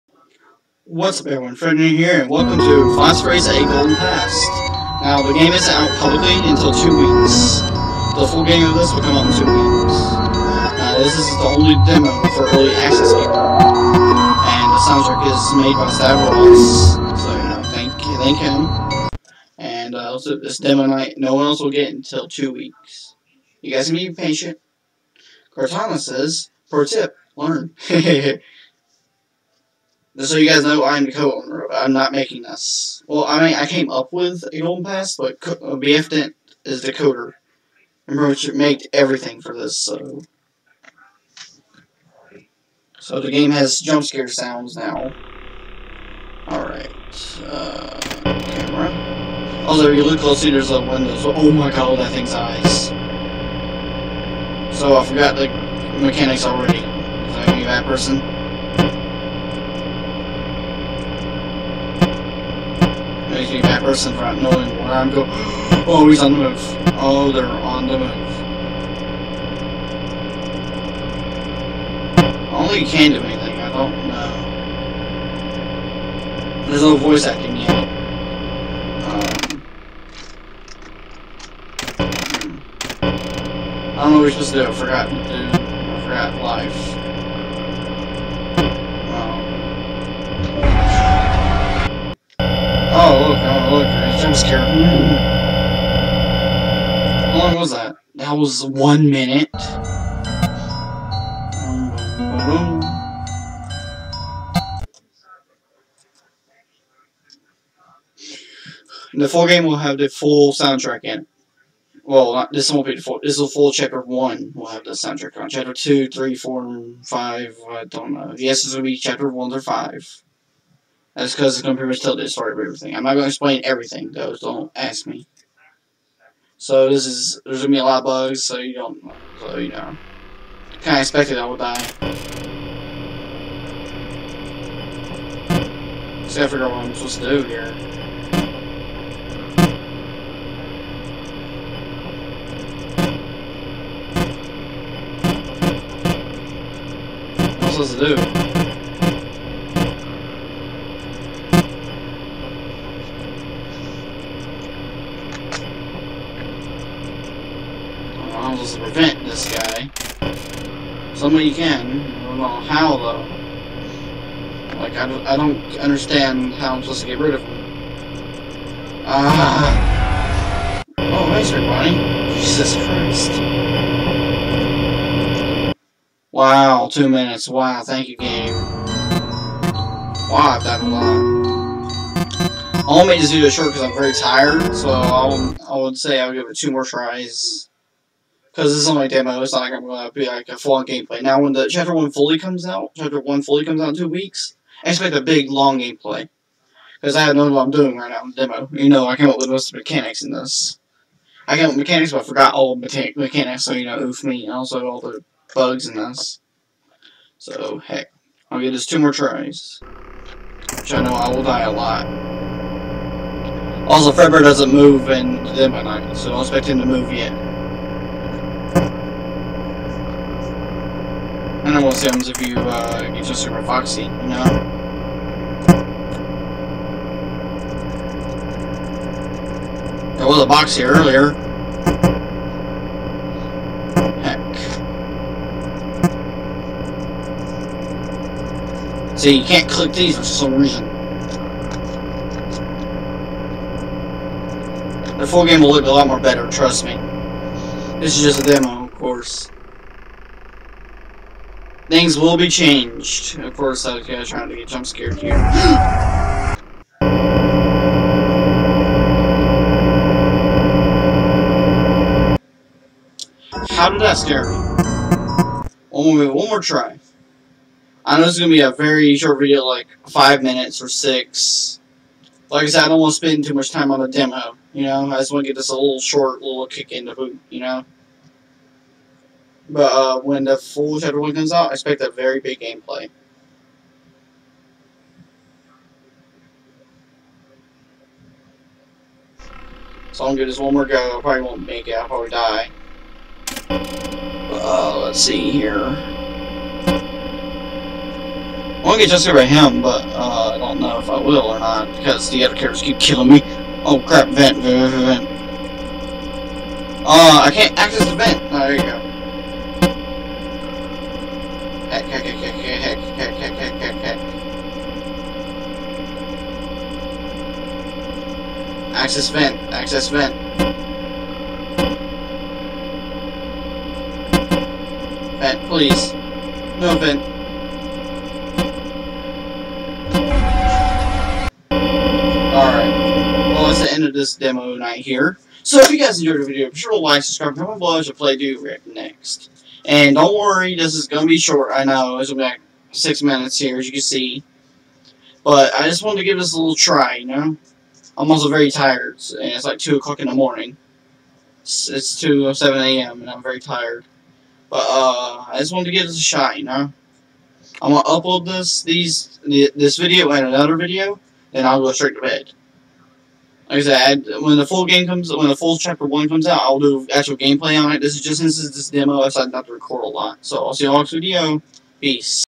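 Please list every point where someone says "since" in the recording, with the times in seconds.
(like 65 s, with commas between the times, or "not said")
368 s.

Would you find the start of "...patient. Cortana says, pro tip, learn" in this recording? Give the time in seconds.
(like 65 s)
24 s.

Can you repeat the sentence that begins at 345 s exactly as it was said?
But I just wanted to give this a little try, you know?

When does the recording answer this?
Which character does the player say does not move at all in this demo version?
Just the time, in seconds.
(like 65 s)
214 s.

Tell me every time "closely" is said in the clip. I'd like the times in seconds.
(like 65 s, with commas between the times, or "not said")
50 s.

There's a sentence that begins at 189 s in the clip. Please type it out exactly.
It's not going to be like a full-on gameplay.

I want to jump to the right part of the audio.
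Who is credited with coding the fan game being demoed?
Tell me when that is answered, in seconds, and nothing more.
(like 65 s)
35 s.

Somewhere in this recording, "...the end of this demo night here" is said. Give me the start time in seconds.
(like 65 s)
333 s.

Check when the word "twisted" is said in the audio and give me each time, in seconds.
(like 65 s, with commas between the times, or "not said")
not said.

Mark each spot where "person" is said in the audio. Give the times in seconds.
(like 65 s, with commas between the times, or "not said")
57 s, 63 s.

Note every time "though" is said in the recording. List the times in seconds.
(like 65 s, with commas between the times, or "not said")
124 s, 162 s.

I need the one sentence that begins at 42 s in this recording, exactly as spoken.
So the game has jump scare sounds now.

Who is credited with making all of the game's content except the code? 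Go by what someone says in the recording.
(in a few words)
Roach.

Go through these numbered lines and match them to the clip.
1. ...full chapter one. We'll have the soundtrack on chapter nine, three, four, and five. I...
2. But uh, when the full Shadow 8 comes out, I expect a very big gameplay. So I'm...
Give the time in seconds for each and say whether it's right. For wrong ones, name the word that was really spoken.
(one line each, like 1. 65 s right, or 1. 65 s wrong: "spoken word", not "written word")
1. 113 s wrong: "two", not "nine"
2. 279 s wrong: "1", not "8".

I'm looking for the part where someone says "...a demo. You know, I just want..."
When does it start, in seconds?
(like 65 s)
274 s.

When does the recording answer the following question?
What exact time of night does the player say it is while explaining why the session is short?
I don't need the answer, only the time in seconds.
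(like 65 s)
352 s.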